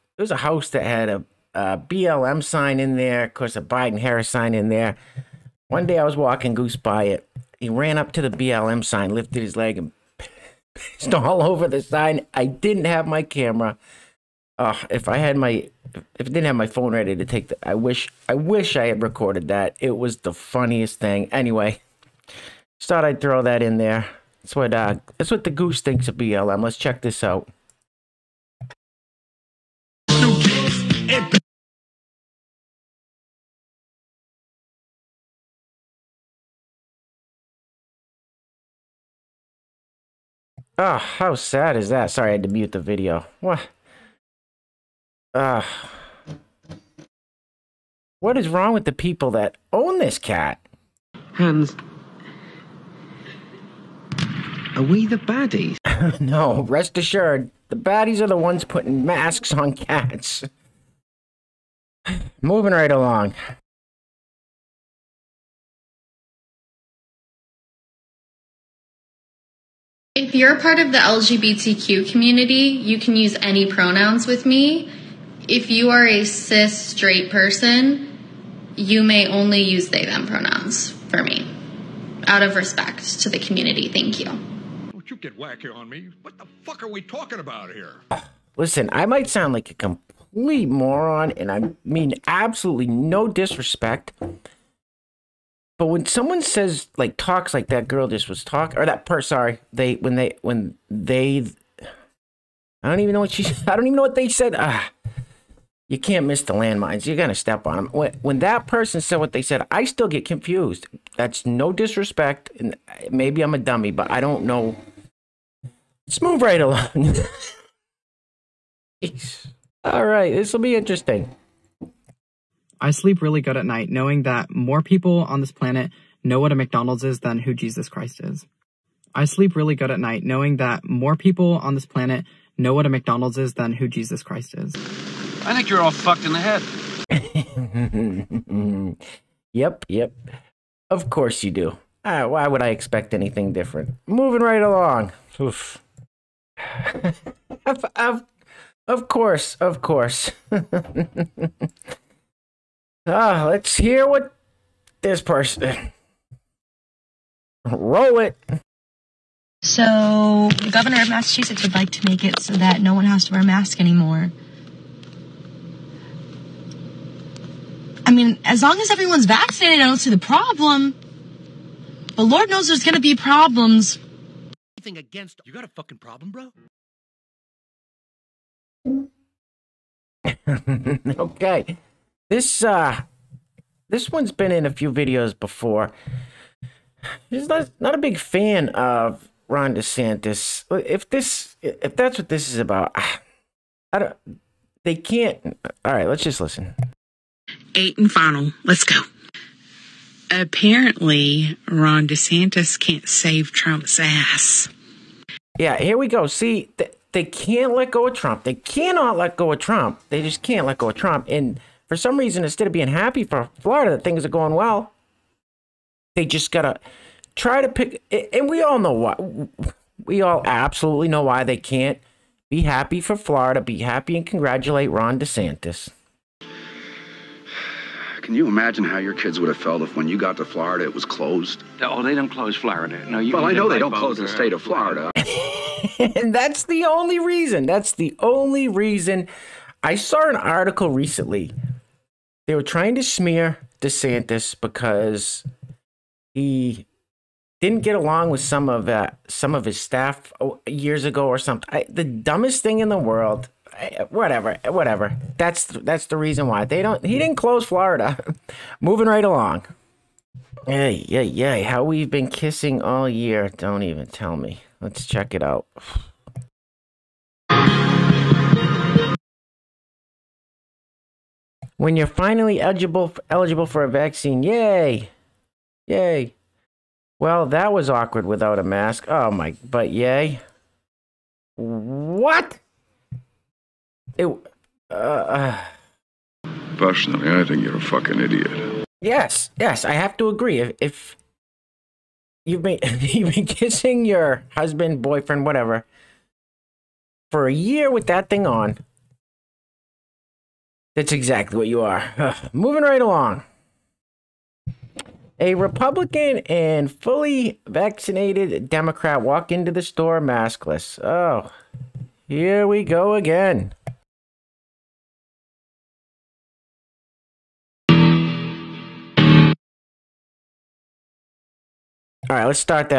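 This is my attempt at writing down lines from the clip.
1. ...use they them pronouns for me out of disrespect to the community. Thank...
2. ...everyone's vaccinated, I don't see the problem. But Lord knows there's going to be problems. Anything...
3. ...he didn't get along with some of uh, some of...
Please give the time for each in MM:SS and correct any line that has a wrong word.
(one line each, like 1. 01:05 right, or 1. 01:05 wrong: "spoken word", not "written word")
1. 01:19 wrong: "respect", not "disrespect"
2. 02:48 right
3. 04:06 right.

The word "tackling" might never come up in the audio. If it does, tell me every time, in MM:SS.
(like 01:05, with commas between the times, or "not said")
not said.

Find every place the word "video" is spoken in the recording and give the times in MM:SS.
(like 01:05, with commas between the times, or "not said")
00:42, 03:04.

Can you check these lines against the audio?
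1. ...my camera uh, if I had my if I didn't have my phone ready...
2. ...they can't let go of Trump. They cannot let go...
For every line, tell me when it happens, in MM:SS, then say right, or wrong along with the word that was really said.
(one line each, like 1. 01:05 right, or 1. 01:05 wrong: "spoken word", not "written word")
1. 00:13 right
2. 03:27 right.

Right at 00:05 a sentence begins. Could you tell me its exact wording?
One day I was walking goose by it.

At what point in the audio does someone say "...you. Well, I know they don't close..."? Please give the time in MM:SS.
03:53.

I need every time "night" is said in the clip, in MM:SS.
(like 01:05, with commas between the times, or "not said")
02:03, 02:09.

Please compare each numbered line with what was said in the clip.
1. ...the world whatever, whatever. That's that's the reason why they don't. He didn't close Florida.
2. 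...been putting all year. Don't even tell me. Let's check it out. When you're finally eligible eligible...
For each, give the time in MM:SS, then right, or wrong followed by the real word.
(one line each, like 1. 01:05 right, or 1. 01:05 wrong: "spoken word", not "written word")
1. 04:12 right
2. 04:22 wrong: "kissing", not "putting".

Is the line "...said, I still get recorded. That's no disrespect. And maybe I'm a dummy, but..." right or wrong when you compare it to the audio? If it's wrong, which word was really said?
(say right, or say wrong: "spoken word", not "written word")
wrong: "confused", not "recorded".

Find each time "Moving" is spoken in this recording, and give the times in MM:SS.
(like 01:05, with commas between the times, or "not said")
01:02, 02:24, 04:18, 05:02.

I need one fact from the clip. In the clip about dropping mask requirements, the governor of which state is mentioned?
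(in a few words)
Massachusetts.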